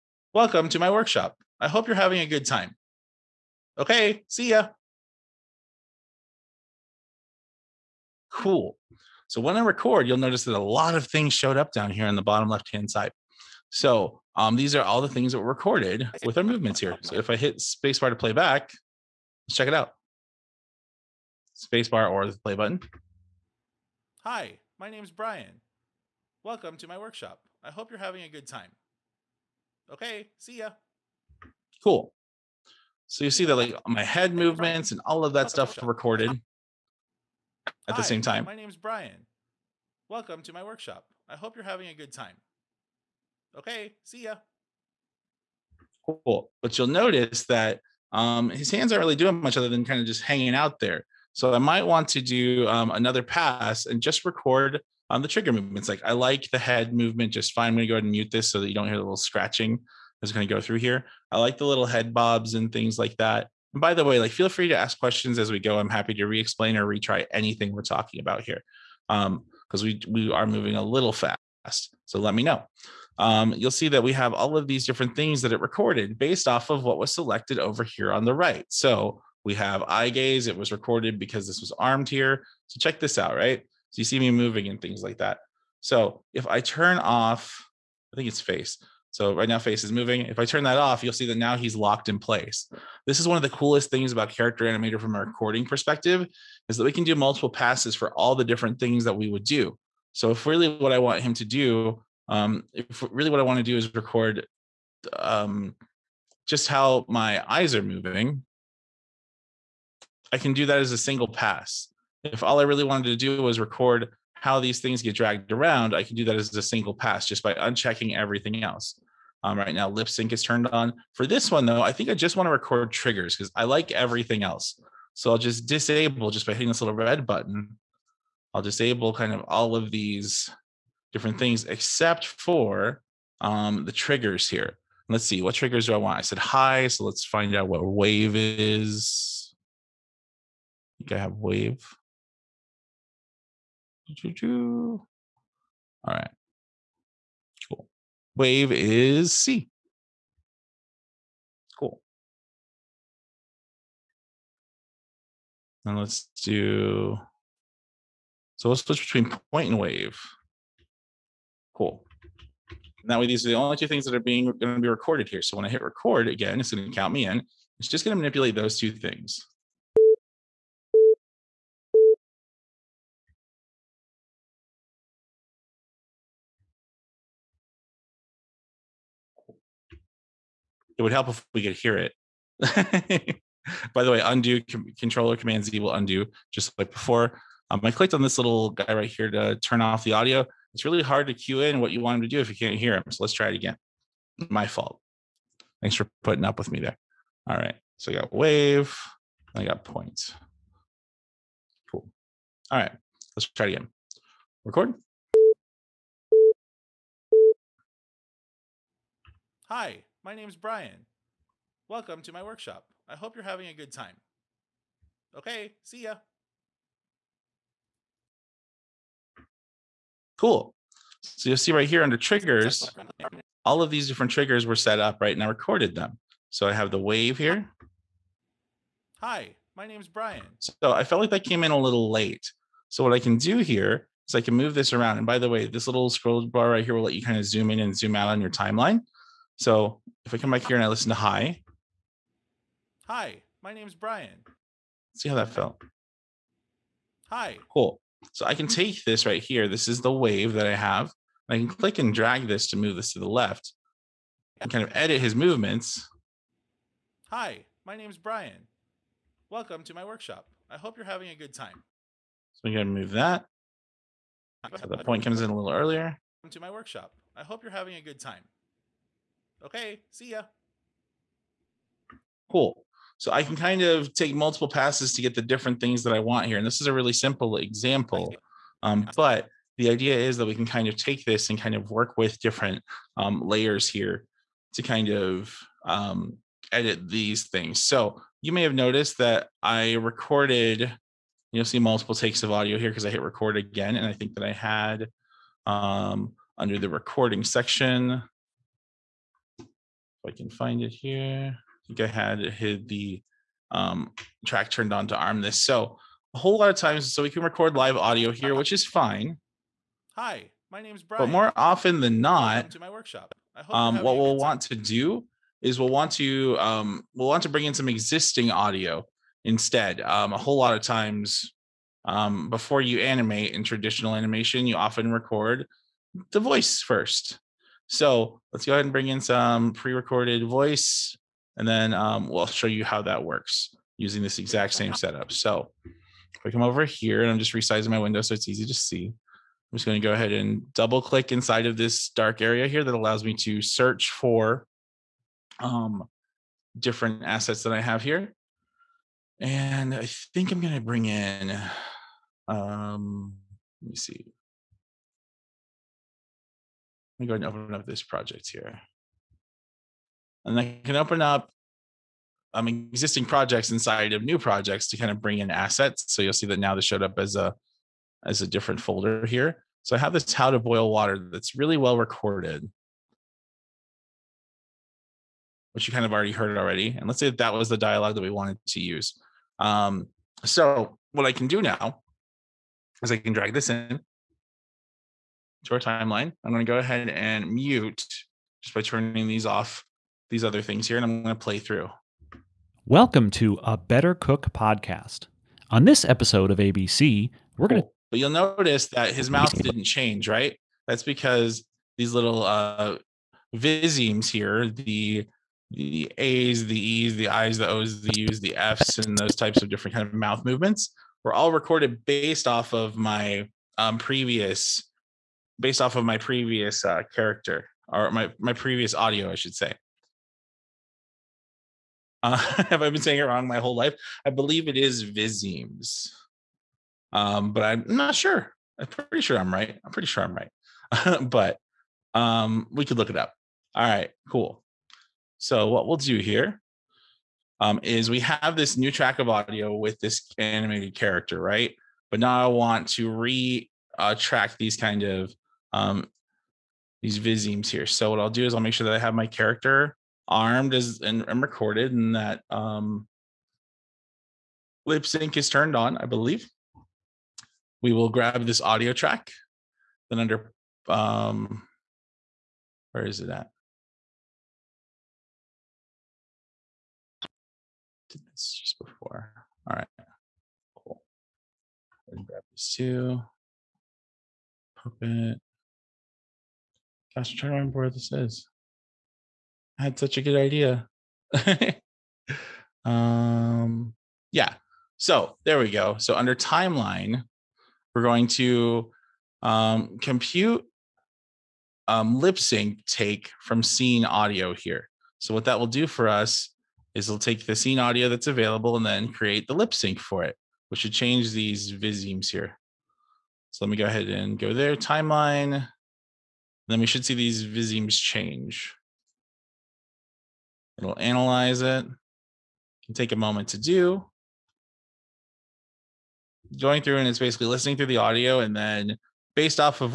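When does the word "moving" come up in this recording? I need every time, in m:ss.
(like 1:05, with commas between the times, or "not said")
1:10, 1:24, 1:29, 1:47.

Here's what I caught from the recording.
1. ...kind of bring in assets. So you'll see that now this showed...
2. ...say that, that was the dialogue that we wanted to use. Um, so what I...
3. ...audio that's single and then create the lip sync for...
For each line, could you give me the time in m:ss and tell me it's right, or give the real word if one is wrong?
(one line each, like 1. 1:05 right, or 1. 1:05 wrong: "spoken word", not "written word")
1. 6:04 right
2. 6:17 right
3. 8:17 wrong: "available", not "single".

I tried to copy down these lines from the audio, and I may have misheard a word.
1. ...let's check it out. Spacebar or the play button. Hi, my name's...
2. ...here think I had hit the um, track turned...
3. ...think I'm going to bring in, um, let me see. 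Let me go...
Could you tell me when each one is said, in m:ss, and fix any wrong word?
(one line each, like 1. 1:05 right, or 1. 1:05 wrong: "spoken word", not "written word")
1. 0:19 right
2. 5:00 right
3. 5:50 right.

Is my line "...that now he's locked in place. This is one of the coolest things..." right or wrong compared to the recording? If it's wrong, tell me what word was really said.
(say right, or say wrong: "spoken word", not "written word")
right.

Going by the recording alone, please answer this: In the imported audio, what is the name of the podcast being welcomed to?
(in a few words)
A Better Cook.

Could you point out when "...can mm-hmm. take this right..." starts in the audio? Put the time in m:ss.
4:08.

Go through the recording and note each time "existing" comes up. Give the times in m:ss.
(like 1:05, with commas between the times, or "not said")
5:17, 6:02.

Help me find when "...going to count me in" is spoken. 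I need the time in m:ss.
2:46.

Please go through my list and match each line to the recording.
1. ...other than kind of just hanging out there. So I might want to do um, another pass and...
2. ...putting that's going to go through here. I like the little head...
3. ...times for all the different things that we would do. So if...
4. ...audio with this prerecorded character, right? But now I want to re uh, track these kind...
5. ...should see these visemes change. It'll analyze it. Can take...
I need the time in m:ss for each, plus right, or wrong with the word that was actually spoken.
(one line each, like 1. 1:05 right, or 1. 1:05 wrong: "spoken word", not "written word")
1. 0:49 right
2. 0:59 wrong: "scratching", not "putting"
3. 1:37 wrong: "passes", not "times"
4. 7:19 wrong: "animated", not "prerecorded"
5. 8:26 right.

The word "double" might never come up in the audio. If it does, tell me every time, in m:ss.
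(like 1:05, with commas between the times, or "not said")
5:40.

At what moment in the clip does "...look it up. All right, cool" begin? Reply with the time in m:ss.
7:12.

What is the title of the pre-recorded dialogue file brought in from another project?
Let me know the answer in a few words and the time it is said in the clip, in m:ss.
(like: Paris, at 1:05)
How to boil water, at 6:10.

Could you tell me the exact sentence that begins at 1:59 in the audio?
Um, right now, lip sync is turned on.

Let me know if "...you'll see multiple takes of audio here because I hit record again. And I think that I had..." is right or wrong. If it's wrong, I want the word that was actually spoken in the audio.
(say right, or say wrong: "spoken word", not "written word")
right.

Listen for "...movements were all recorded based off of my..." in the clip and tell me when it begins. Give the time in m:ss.
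6:50.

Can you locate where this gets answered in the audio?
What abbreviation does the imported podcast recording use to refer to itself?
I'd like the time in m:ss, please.
6:36.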